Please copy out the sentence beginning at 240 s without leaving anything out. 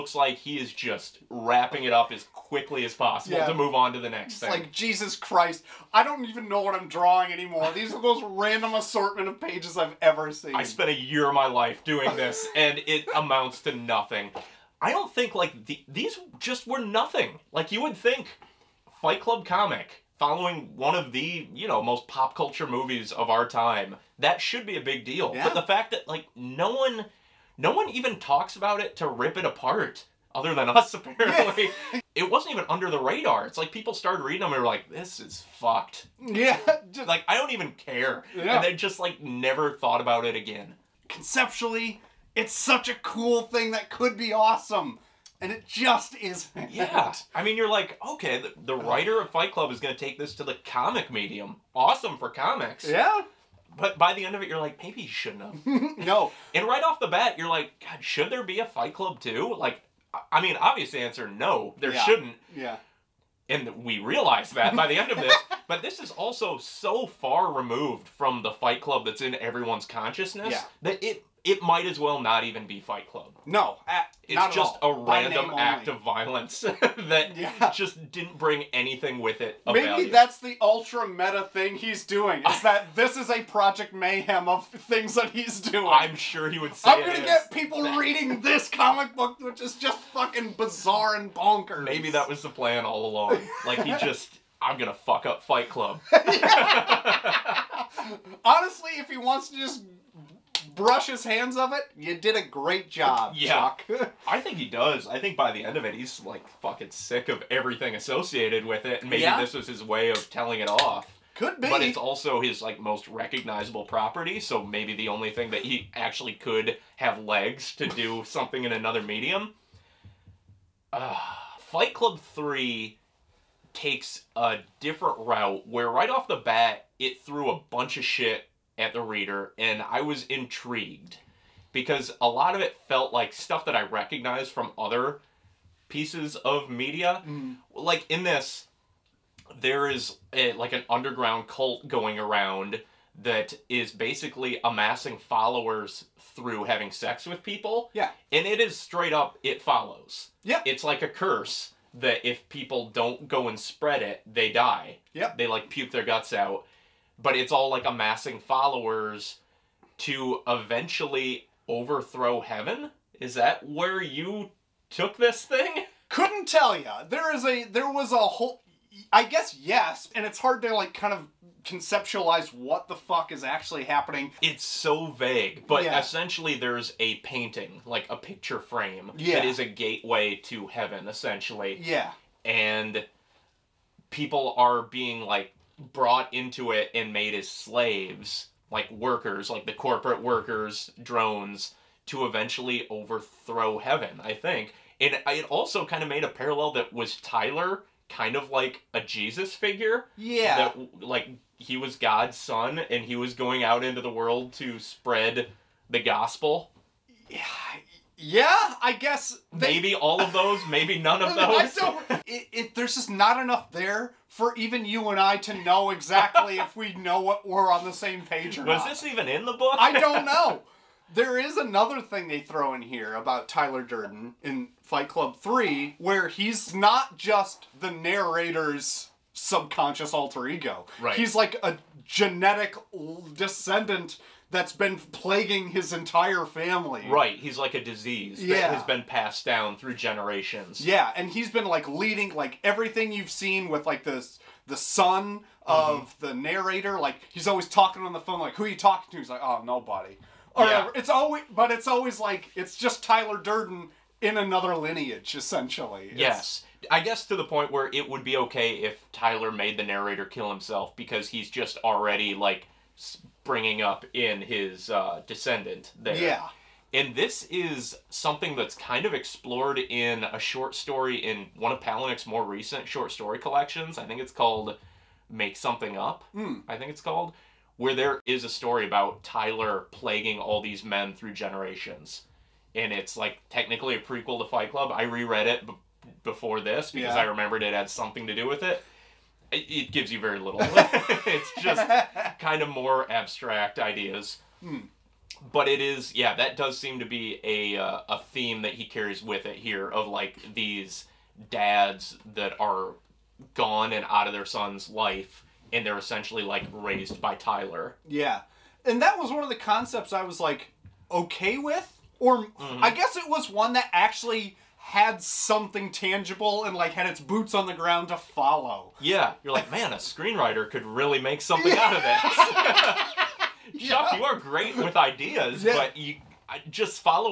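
Yeah, and he's been like leading like everything you've seen with like this the son of mm-hmm.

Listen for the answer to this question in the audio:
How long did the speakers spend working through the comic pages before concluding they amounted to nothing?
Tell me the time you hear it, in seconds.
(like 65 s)
10 s.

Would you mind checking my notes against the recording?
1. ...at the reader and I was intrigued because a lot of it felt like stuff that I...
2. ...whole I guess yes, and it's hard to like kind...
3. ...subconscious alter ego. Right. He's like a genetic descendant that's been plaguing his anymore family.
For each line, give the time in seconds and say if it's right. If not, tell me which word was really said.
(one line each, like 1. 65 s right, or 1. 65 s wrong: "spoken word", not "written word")
1. 128 s right
2. 168 s right
3. 229 s wrong: "entire", not "anymore".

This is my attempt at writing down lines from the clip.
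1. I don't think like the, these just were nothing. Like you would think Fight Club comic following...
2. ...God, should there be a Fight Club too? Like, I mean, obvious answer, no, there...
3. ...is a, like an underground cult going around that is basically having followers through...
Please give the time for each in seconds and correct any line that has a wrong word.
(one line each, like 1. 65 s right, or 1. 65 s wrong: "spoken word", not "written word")
1. 14 s right
2. 57 s right
3. 139 s wrong: "amassing", not "having".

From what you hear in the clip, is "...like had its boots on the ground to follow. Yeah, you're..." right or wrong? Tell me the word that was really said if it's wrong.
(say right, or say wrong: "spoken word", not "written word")
right.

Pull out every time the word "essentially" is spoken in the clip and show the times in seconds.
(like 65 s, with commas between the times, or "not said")
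175 s, 181 s, 255 s, 305 s.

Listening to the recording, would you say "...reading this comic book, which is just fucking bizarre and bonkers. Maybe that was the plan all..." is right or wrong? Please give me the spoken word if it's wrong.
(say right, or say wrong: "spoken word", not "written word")
right.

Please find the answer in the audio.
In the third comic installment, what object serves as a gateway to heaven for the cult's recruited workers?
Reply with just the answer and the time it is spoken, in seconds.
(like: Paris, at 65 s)
a painting, at 176 s.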